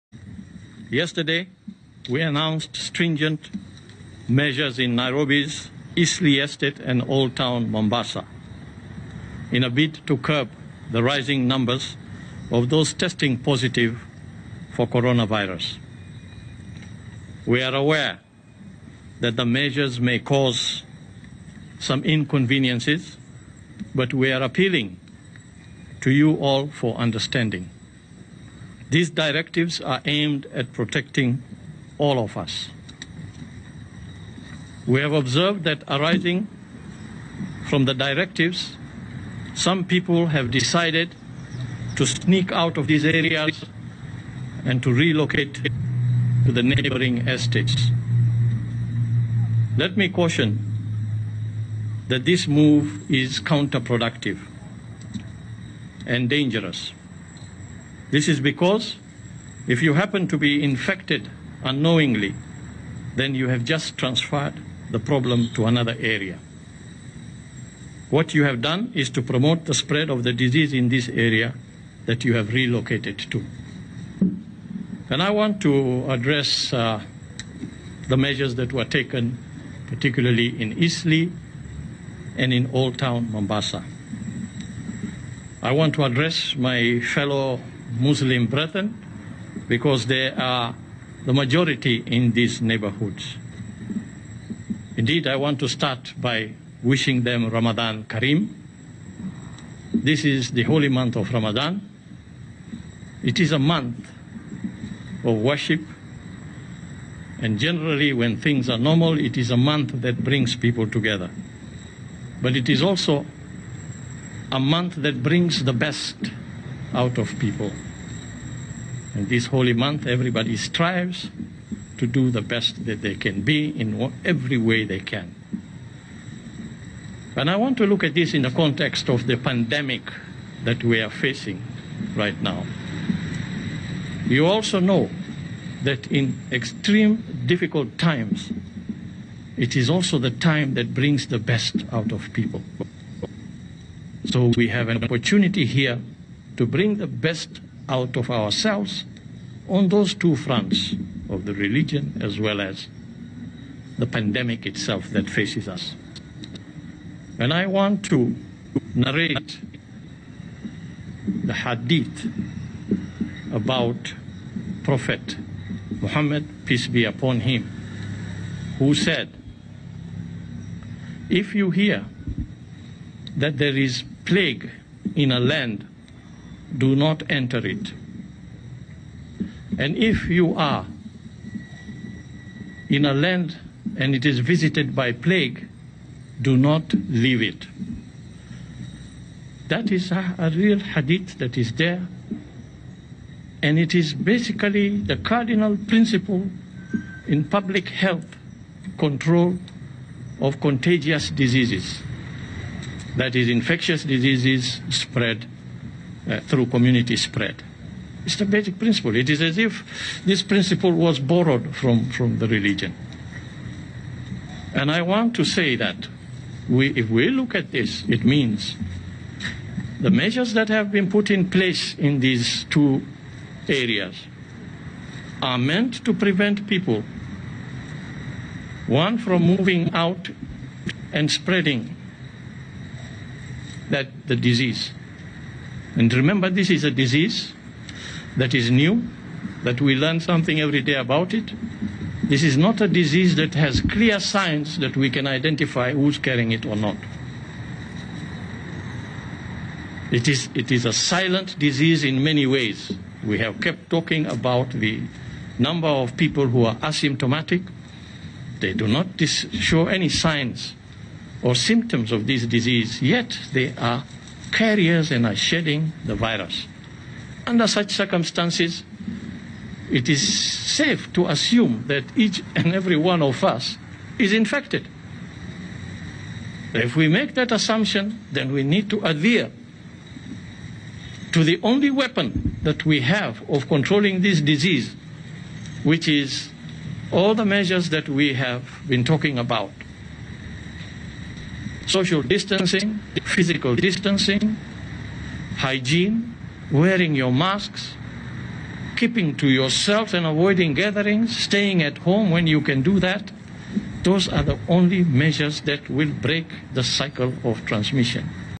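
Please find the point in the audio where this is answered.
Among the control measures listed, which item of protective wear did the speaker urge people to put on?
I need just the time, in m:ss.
4:57.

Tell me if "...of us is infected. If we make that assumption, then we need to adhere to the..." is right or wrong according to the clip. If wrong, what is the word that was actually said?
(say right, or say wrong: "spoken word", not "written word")
right.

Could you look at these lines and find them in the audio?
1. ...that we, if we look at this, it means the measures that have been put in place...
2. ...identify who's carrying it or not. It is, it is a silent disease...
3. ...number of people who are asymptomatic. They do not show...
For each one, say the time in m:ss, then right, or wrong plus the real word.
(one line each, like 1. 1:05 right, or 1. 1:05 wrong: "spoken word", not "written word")
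1. 3:35 right
2. 4:05 right
3. 4:15 right.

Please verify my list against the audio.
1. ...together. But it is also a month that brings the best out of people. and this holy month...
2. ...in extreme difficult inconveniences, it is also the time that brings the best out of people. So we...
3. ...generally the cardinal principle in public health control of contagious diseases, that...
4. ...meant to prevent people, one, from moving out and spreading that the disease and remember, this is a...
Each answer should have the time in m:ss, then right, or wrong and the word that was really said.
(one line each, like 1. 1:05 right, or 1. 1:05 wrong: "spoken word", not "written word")
1. 1:50 right
2. 2:16 wrong: "times", not "inconveniences"
3. 3:14 wrong: "basically", not "generally"
4. 3:45 right.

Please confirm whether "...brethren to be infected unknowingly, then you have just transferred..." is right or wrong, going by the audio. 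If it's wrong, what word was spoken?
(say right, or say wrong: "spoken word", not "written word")
wrong: "happen", not "brethren".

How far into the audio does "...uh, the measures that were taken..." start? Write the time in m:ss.
1:16.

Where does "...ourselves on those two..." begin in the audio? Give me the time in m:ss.
2:28.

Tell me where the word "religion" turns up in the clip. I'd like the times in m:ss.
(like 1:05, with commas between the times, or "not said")
2:31, 3:32.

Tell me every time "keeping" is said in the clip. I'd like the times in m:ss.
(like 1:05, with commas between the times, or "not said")
4:58.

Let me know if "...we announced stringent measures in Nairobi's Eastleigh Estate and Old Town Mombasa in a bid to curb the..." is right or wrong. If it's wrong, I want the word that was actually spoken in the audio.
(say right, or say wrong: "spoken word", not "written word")
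right.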